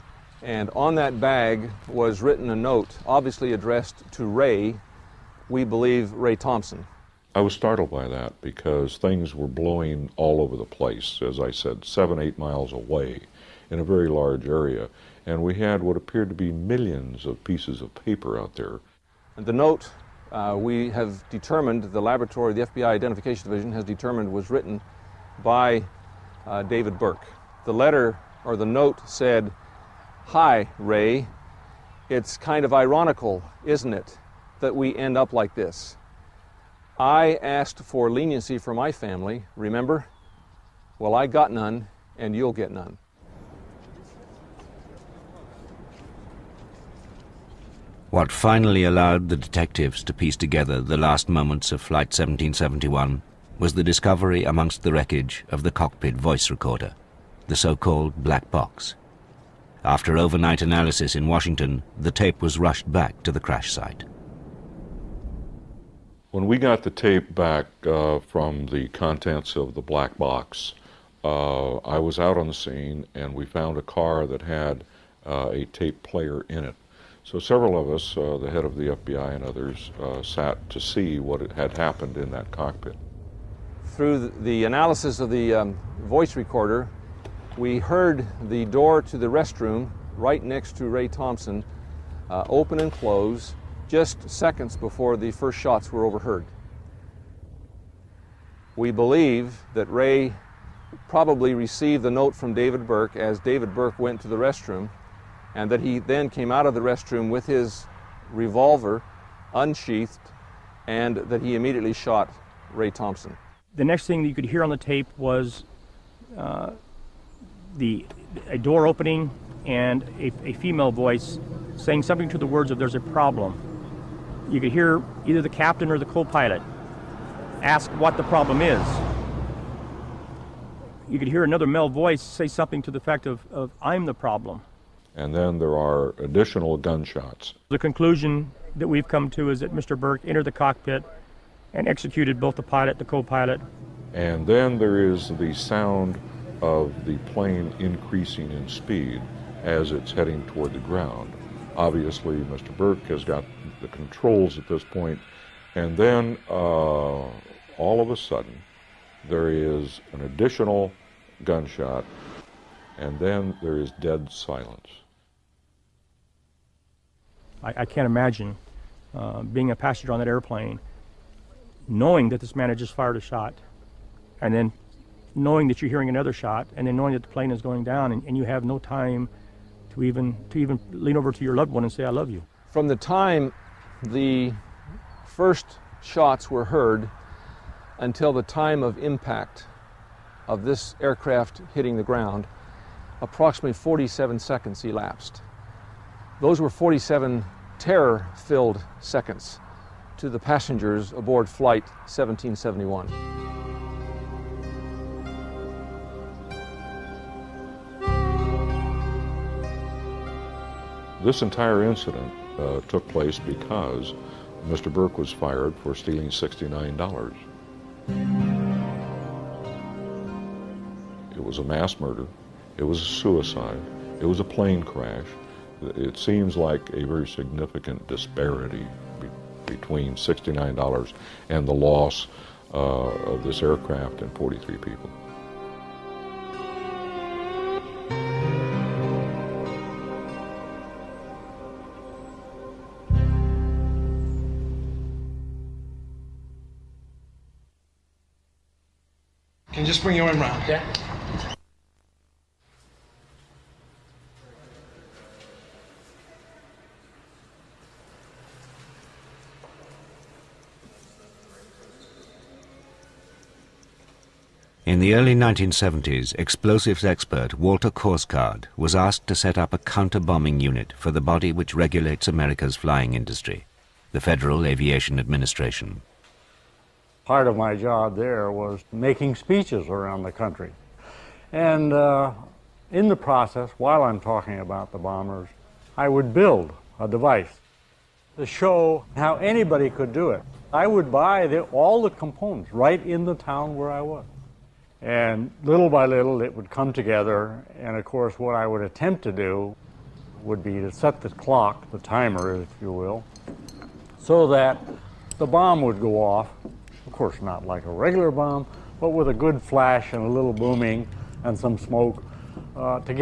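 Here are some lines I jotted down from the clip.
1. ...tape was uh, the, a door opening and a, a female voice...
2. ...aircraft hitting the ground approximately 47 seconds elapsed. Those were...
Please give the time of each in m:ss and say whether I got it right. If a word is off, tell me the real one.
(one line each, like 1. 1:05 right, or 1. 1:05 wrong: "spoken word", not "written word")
1. 1:54 right
2. 3:11 right.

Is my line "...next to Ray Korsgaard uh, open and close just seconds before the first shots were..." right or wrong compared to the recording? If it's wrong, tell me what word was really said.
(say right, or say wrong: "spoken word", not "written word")
wrong: "Thompson", not "Korsgaard".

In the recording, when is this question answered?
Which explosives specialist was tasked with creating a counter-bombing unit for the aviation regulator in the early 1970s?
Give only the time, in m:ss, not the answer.
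4:27.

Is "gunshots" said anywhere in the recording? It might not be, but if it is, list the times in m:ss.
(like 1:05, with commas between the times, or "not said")
2:16, 2:41.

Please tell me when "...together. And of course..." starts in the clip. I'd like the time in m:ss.
4:56.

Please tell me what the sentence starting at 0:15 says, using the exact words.
And we had what appeared to be millions of pieces of paper out there.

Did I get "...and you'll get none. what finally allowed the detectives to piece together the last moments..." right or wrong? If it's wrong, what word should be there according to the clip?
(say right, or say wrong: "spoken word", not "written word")
right.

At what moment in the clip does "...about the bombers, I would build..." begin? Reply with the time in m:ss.
4:44.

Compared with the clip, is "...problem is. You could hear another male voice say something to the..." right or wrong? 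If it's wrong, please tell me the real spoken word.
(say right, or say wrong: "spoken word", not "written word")
right.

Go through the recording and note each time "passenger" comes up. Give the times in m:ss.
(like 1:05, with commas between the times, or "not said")
2:49, 3:20.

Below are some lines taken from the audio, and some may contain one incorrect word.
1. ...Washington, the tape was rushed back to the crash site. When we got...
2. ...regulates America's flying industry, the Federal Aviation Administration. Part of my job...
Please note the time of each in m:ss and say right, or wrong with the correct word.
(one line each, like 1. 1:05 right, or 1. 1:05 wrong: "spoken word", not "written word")
1. 1:01 right
2. 4:31 right.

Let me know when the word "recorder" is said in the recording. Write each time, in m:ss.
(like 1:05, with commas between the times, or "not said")
0:56, 1:26.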